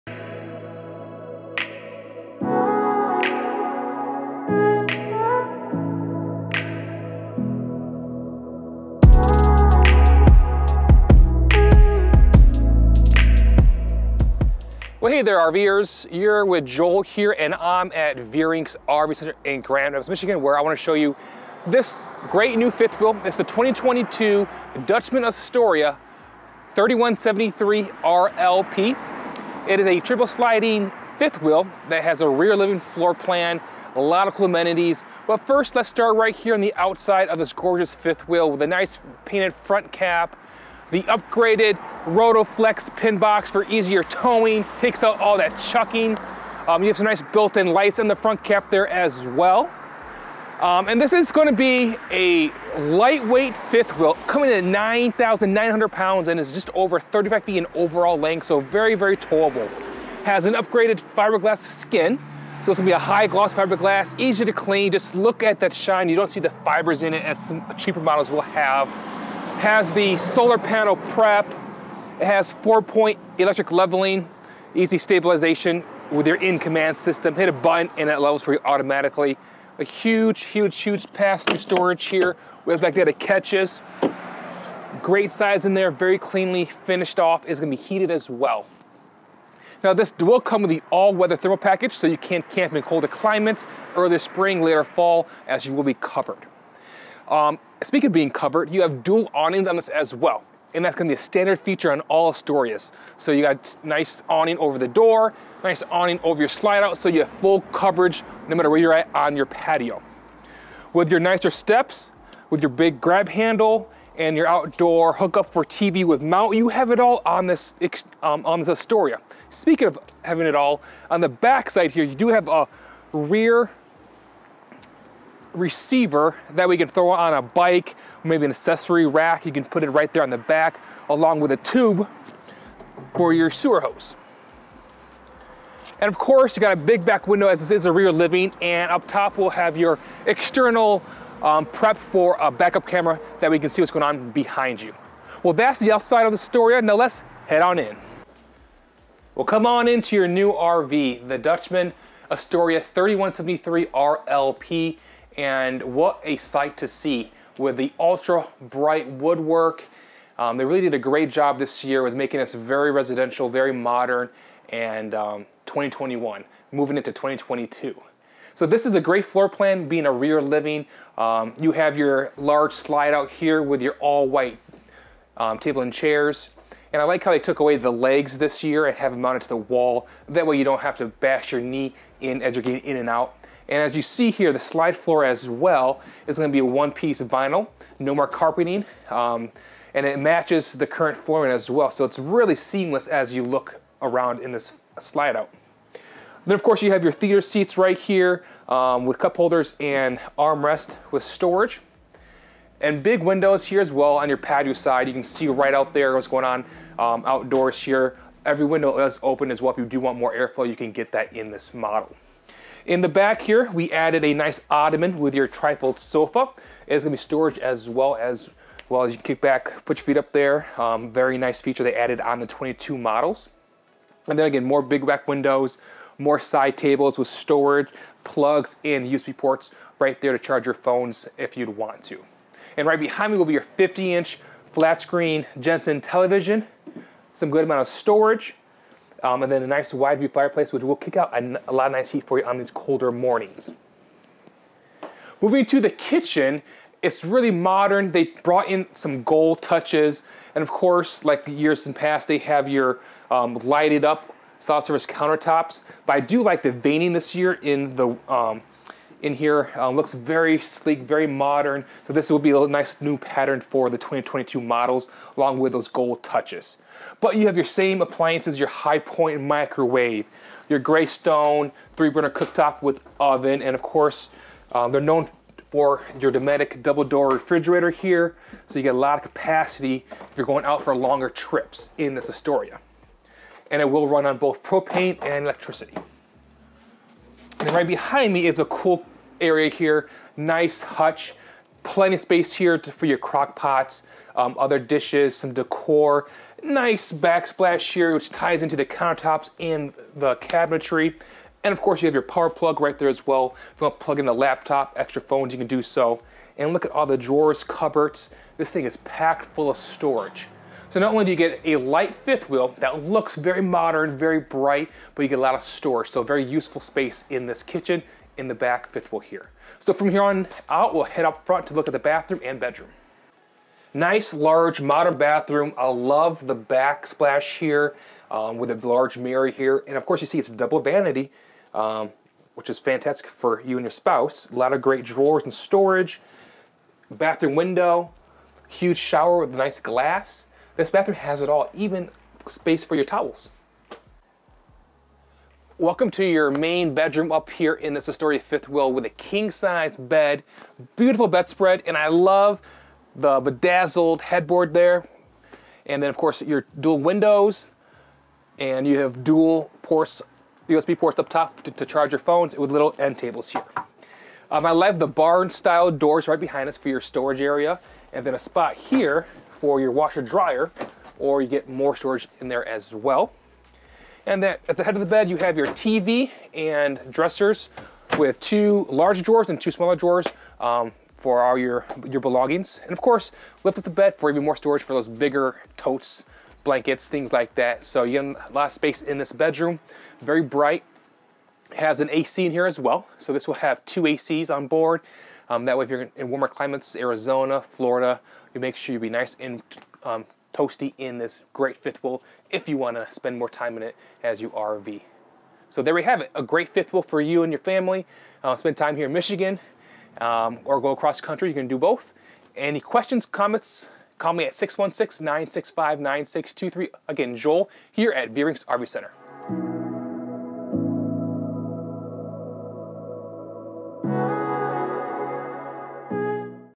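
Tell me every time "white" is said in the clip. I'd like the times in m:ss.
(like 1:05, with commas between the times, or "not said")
2:54.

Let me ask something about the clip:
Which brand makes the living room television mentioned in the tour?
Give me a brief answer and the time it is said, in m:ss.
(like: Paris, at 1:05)
Jensen, at 3:55.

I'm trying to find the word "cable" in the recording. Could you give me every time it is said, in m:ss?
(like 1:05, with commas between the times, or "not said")
not said.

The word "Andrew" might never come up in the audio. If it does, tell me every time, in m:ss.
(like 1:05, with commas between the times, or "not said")
not said.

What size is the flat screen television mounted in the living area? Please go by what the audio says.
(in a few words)
50 inch.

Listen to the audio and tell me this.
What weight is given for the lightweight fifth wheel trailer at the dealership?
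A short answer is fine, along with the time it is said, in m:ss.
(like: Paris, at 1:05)
9,900 pounds, at 0:54.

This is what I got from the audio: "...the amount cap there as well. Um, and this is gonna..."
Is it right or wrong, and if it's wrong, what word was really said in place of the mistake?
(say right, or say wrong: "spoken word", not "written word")
wrong: "front", not "amount".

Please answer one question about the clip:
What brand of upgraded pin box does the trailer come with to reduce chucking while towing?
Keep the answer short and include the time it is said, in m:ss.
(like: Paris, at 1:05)
Rotoflex, at 0:42.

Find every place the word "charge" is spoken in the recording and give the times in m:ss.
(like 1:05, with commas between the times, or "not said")
3:50, 6:01.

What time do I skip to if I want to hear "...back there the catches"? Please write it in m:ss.
1:22.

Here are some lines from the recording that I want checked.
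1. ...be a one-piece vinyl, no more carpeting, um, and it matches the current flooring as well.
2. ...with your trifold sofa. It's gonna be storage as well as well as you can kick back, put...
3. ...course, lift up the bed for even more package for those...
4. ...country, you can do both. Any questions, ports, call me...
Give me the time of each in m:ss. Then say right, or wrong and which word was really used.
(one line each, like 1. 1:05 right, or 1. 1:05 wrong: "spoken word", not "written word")
1. 3:06 right
2. 3:35 right
3. 6:23 wrong: "storage", not "package"
4. 6:51 wrong: "comments", not "ports".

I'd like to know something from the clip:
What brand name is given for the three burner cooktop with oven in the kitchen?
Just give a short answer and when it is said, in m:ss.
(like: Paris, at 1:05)
Greystone, at 4:30.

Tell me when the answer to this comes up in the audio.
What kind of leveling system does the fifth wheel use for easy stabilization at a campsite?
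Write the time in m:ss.
1:12.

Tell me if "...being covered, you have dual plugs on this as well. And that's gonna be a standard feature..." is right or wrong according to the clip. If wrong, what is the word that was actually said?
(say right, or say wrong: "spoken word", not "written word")
wrong: "awnings", not "plugs".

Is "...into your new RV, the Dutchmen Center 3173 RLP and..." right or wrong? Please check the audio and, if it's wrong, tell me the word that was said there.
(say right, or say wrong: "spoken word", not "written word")
wrong: "Astoria", not "Center".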